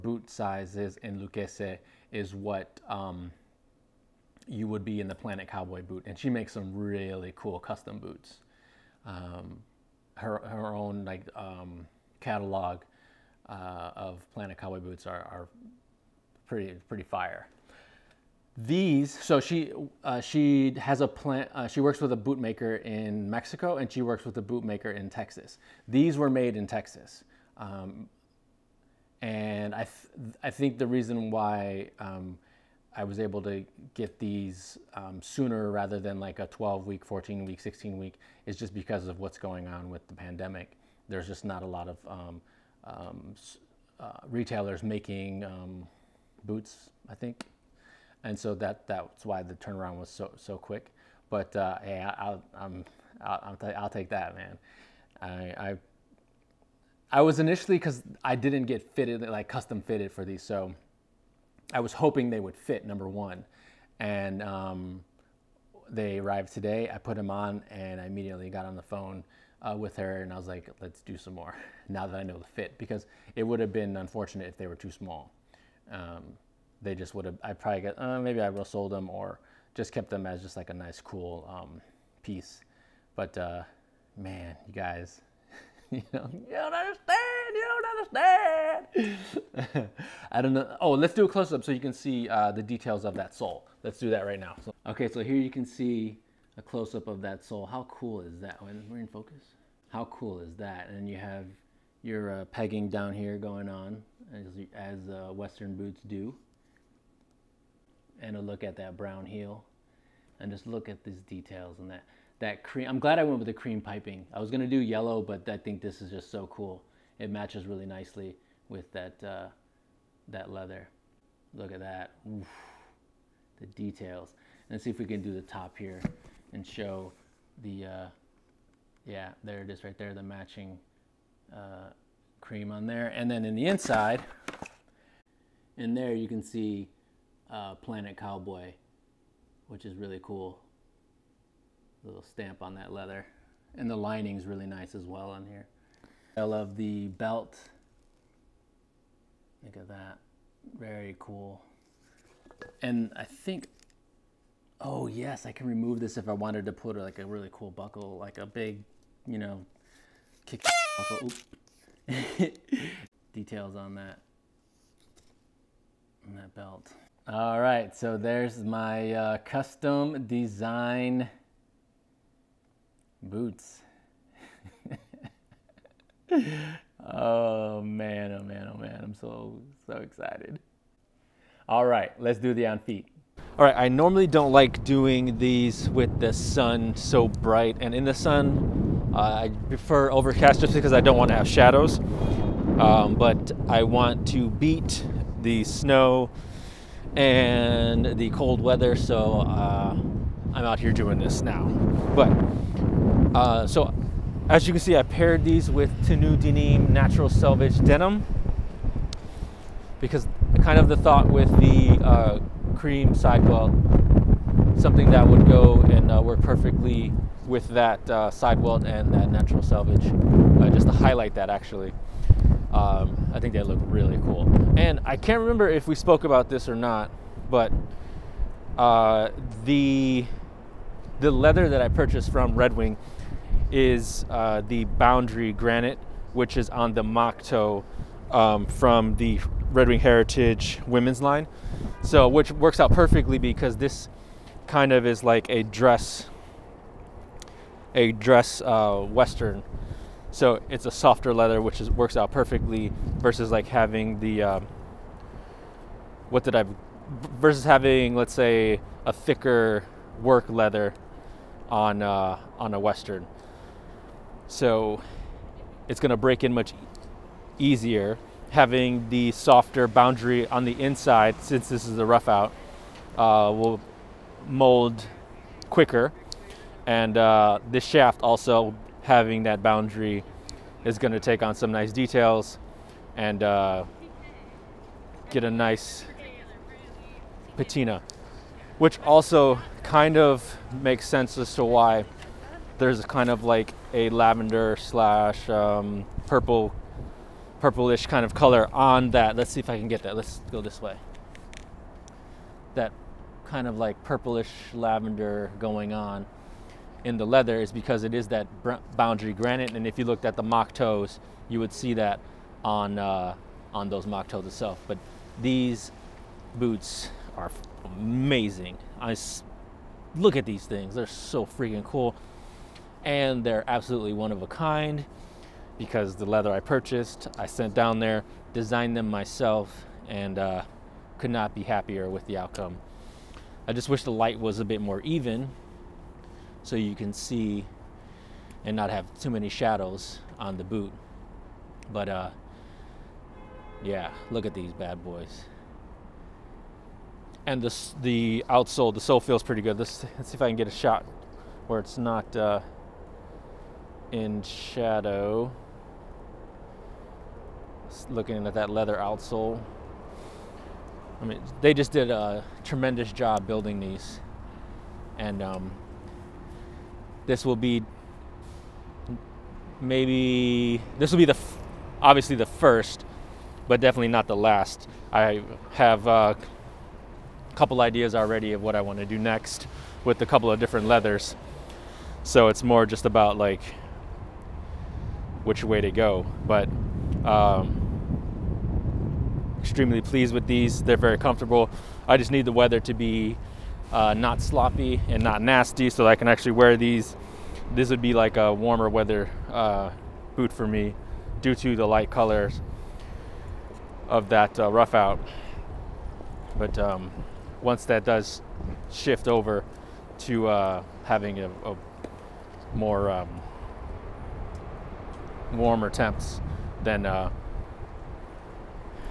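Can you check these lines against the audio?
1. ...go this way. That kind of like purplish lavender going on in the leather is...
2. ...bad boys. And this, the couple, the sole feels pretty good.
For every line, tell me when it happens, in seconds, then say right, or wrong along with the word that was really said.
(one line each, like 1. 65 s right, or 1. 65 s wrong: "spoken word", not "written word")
1. 300 s right
2. 344 s wrong: "outsole", not "couple".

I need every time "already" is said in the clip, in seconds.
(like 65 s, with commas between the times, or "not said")
378 s.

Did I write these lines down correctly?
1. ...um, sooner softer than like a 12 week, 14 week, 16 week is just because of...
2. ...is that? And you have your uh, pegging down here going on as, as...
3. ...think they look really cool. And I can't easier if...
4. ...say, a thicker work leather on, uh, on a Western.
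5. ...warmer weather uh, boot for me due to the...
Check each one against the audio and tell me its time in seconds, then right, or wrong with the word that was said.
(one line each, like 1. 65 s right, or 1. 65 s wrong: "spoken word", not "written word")
1. 34 s wrong: "rather", not "softer"
2. 100 s right
3. 223 s wrong: "remember", not "easier"
4. 258 s right
5. 398 s right.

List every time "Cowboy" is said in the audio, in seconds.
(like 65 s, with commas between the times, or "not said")
5 s, 14 s, 138 s.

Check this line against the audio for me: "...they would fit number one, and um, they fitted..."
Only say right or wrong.
wrong.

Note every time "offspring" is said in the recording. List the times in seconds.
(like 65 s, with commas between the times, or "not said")
not said.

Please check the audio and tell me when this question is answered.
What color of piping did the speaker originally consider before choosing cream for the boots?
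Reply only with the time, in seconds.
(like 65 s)
114 s.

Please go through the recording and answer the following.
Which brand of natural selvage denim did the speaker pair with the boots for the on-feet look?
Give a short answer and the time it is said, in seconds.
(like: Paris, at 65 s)
Tenu Denim, at 206 s.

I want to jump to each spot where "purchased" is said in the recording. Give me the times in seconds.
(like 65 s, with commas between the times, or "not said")
231 s, 326 s.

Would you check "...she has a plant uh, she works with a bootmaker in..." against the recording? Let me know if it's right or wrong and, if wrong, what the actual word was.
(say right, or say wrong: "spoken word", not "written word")
right.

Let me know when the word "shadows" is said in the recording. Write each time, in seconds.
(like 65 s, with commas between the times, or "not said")
191 s, 339 s, 354 s.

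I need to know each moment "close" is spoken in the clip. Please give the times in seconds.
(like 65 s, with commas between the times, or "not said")
91 s, 96 s.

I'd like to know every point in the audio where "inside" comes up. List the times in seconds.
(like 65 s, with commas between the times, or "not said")
133 s, 270 s.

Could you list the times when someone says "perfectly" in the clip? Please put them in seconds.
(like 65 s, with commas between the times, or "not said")
216 s, 242 s, 252 s.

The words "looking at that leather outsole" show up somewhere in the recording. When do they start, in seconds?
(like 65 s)
358 s.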